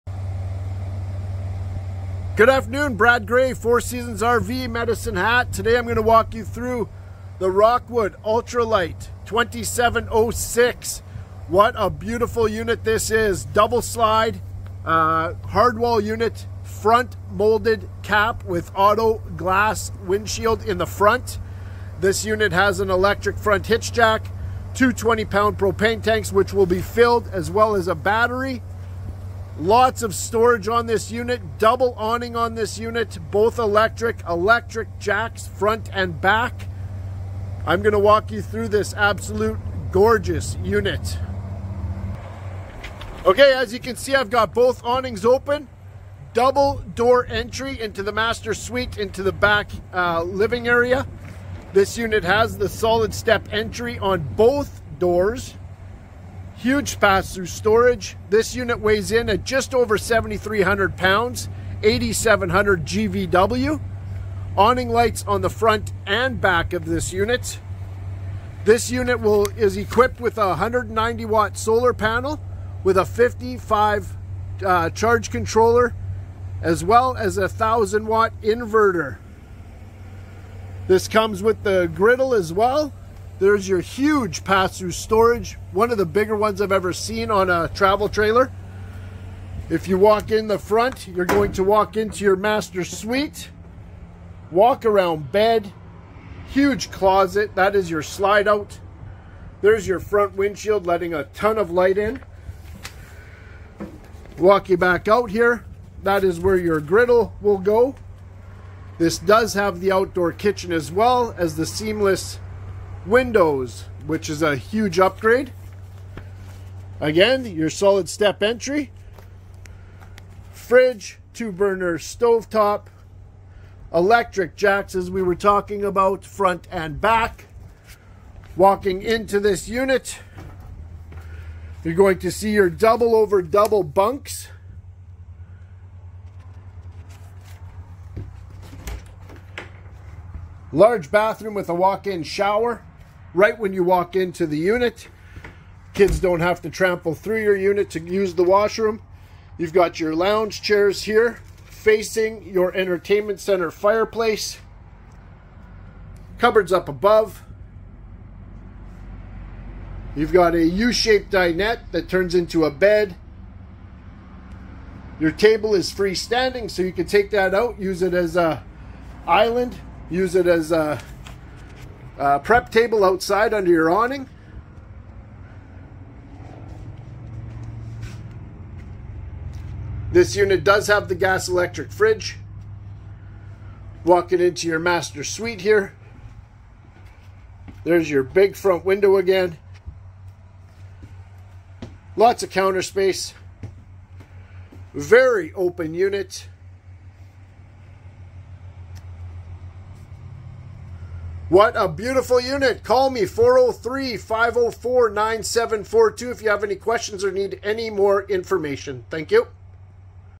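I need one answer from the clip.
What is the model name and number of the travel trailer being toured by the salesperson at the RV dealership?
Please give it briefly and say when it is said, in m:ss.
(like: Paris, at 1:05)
Rockwood Ultra Lite 2706, at 0:07.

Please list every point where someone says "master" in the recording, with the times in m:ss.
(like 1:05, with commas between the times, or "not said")
0:48, 1:32, 3:04.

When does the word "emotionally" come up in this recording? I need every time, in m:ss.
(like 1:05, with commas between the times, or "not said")
not said.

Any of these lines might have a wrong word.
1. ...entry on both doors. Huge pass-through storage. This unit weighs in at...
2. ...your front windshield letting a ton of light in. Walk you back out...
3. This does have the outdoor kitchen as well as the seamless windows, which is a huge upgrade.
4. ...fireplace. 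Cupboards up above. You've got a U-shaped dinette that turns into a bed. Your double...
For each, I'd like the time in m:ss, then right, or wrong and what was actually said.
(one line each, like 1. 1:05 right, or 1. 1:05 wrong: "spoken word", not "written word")
1. 0:53 right
2. 1:39 right
3. 1:48 right
4. 2:33 wrong: "table", not "double".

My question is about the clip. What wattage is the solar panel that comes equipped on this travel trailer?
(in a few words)
190 watt.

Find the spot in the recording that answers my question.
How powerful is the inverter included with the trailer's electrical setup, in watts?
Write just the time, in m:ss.
1:17.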